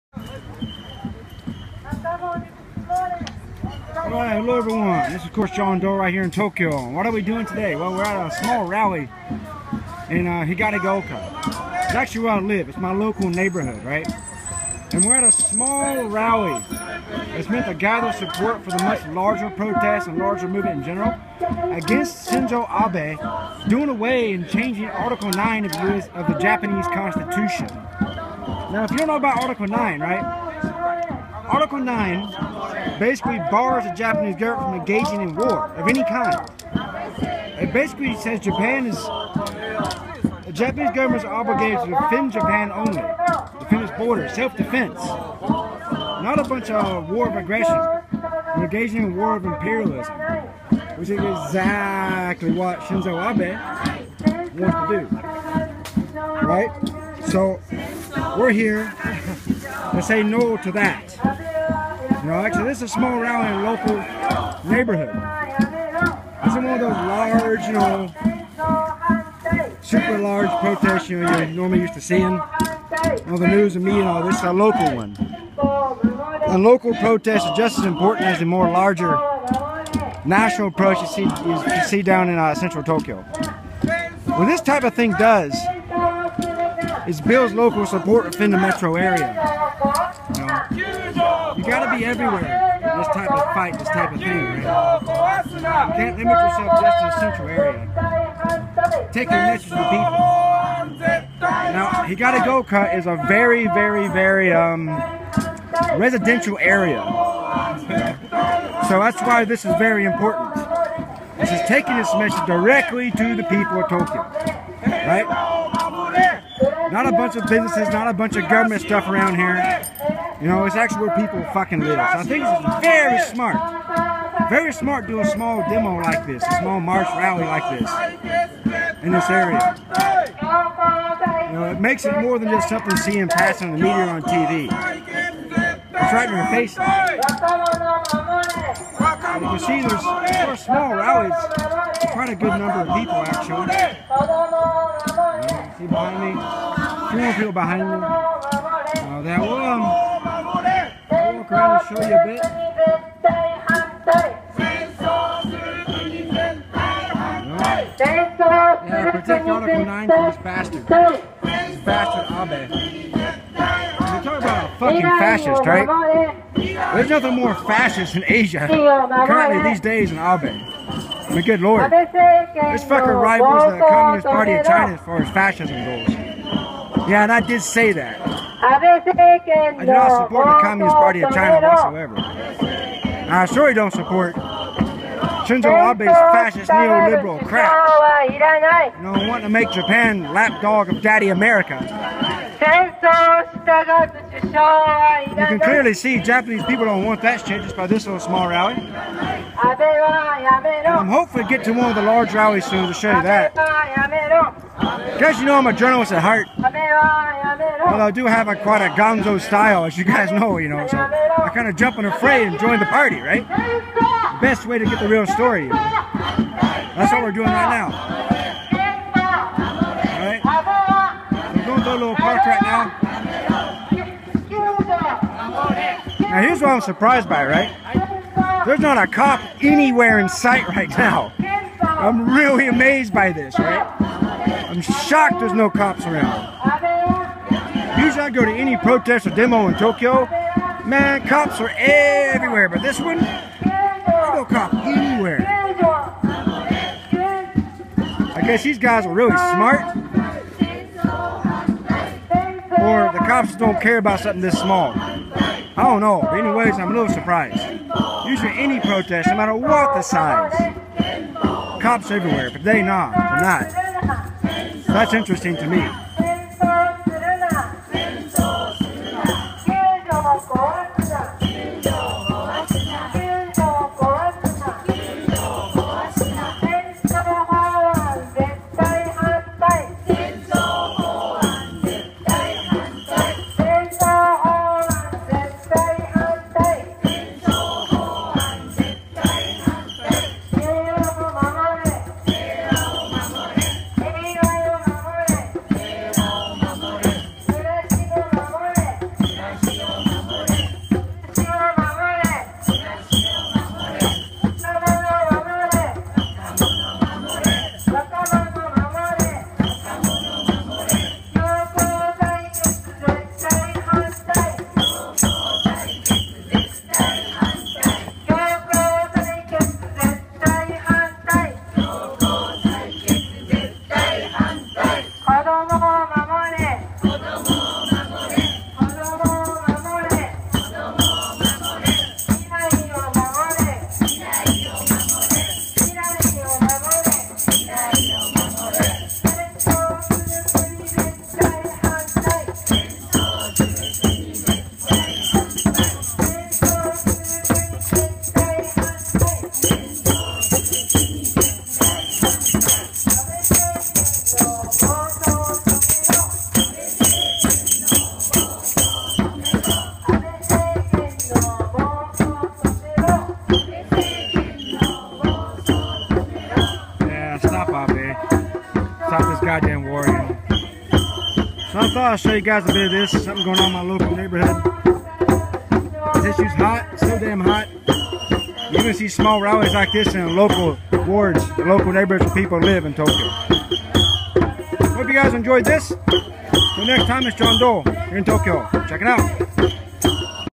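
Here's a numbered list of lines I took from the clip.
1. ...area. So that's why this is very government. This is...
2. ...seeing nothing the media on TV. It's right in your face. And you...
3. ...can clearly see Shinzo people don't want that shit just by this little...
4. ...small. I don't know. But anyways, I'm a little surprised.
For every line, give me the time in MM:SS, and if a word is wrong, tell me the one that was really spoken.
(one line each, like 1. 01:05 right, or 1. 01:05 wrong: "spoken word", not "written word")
1. 01:46 wrong: "important", not "government"
2. 02:12 wrong: "passing", not "nothing"
3. 03:15 wrong: "Japanese", not "Shinzo"
4. 04:14 right.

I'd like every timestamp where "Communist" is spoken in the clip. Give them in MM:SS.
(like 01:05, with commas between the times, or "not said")
02:53, 03:00.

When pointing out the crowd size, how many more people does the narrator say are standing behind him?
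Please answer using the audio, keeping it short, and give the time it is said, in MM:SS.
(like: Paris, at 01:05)
3, at 02:27.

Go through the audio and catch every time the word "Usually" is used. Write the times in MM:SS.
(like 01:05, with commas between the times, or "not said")
03:57, 04:18.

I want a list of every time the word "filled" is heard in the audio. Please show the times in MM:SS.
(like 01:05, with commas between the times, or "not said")
not said.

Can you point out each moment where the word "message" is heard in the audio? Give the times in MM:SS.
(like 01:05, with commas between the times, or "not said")
01:52.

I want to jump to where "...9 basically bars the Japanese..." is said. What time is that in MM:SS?
00:31.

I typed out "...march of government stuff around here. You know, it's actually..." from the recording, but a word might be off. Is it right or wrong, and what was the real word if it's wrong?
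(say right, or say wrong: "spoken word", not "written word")
wrong: "bunch", not "march".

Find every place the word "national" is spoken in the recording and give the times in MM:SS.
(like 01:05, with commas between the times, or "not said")
01:20.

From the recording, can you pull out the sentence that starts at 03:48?
There's not a cop anywhere in sight right now.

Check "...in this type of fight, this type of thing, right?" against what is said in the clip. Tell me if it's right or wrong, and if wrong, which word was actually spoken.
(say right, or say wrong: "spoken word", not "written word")
right.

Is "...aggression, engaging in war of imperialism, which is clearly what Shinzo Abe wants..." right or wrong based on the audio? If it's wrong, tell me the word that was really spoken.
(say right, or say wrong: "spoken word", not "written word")
wrong: "exactly", not "clearly".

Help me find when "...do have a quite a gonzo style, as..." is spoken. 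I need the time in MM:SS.
03:28.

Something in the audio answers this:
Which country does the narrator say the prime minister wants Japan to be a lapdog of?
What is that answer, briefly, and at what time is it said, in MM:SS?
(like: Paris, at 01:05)
America, at 03:11.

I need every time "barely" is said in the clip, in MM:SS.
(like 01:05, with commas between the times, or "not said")
not said.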